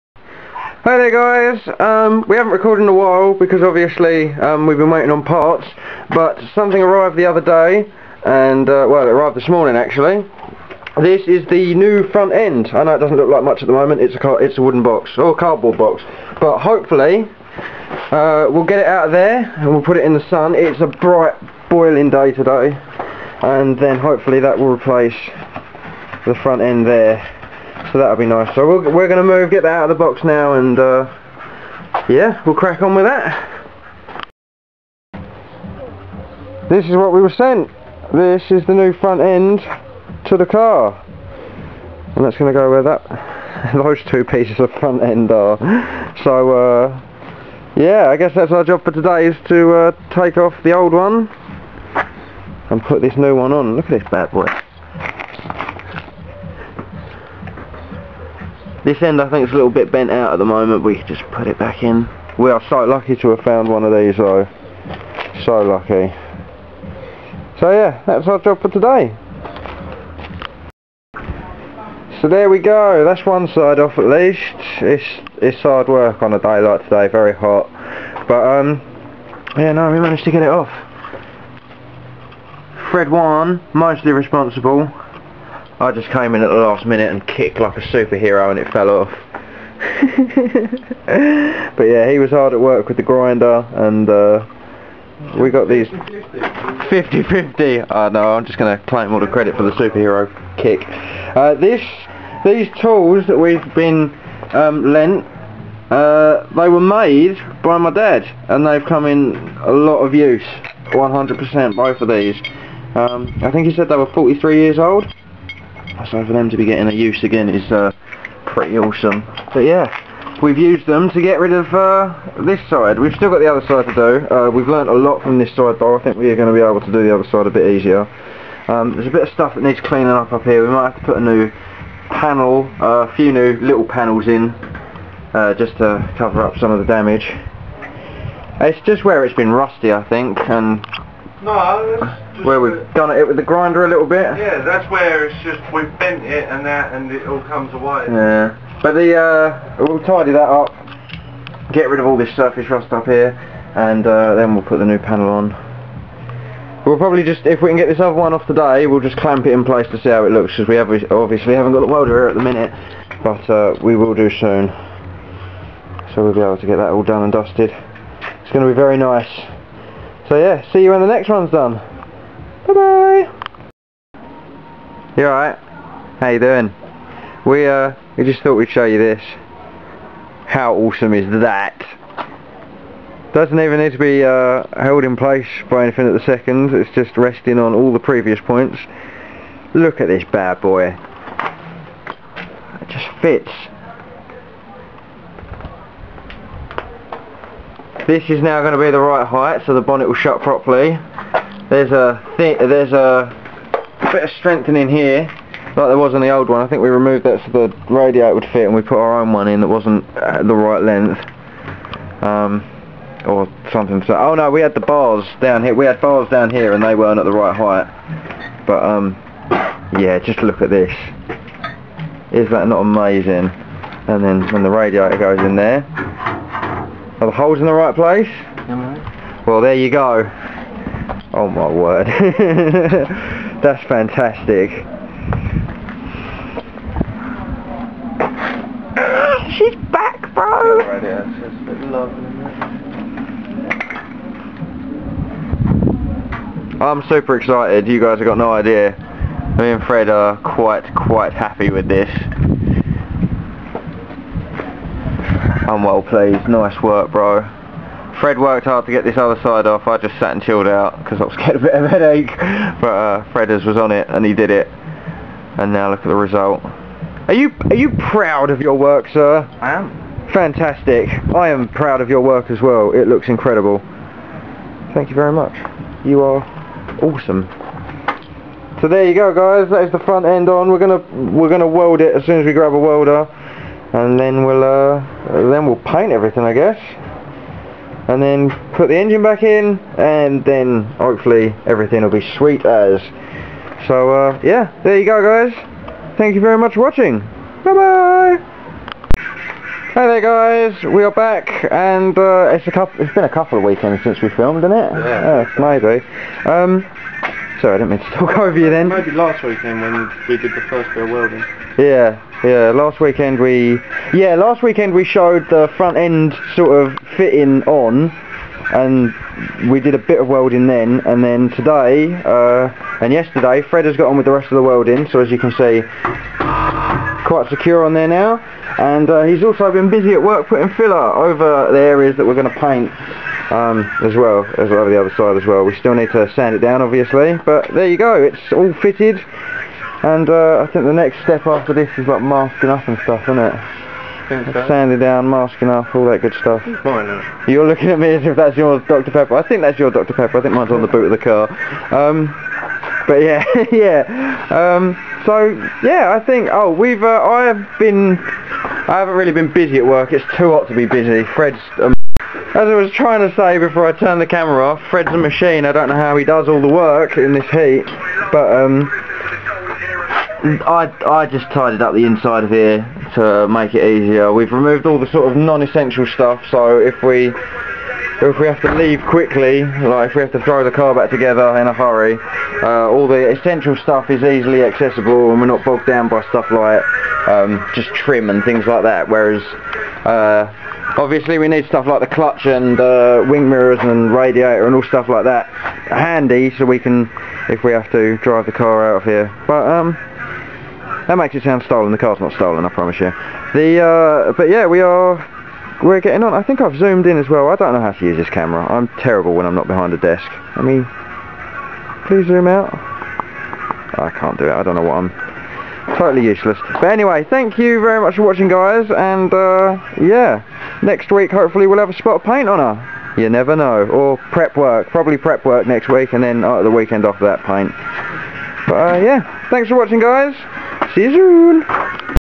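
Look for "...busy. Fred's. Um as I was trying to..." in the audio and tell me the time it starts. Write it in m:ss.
6:00.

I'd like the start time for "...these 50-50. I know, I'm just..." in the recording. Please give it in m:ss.
1:35.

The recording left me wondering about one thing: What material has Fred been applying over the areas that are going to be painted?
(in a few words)
filler.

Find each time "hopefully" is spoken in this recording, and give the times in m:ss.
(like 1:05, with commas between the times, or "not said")
0:16, 0:23, 4:50, 7:01.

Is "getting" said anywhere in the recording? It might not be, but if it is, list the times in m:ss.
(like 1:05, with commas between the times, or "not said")
1:56, 4:21, 6:46.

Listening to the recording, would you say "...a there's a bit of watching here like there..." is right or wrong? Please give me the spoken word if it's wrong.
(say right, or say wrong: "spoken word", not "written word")
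wrong: "strengthening", not "watching".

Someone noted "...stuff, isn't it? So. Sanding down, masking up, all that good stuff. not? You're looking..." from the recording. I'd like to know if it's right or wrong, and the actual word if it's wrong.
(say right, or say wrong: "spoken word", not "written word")
right.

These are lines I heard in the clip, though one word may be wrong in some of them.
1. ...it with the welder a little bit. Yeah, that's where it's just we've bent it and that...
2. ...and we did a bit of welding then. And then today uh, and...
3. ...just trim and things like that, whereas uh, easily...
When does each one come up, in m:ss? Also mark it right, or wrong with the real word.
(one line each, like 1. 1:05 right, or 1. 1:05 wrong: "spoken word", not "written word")
1. 2:23 wrong: "grinder", not "welder"
2. 5:18 right
3. 6:27 wrong: "obviously", not "easily".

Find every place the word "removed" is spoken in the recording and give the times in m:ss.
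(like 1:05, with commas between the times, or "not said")
3:26, 6:14.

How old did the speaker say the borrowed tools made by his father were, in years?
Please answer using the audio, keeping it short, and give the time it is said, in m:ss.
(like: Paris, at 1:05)
43, at 1:54.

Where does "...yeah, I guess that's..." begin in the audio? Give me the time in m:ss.
0:47.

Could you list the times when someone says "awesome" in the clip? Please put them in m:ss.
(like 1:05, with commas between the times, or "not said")
1:58, 3:00, 4:37.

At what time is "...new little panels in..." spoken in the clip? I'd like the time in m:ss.
2:13.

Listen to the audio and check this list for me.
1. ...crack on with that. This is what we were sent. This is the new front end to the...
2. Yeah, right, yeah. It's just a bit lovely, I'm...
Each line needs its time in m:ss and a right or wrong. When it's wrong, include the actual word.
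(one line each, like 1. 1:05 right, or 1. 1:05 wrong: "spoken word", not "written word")
1. 0:32 right
2. 4:00 right.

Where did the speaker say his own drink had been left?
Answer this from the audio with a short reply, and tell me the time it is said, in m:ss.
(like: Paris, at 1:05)
on the boot of the car, at 5:50.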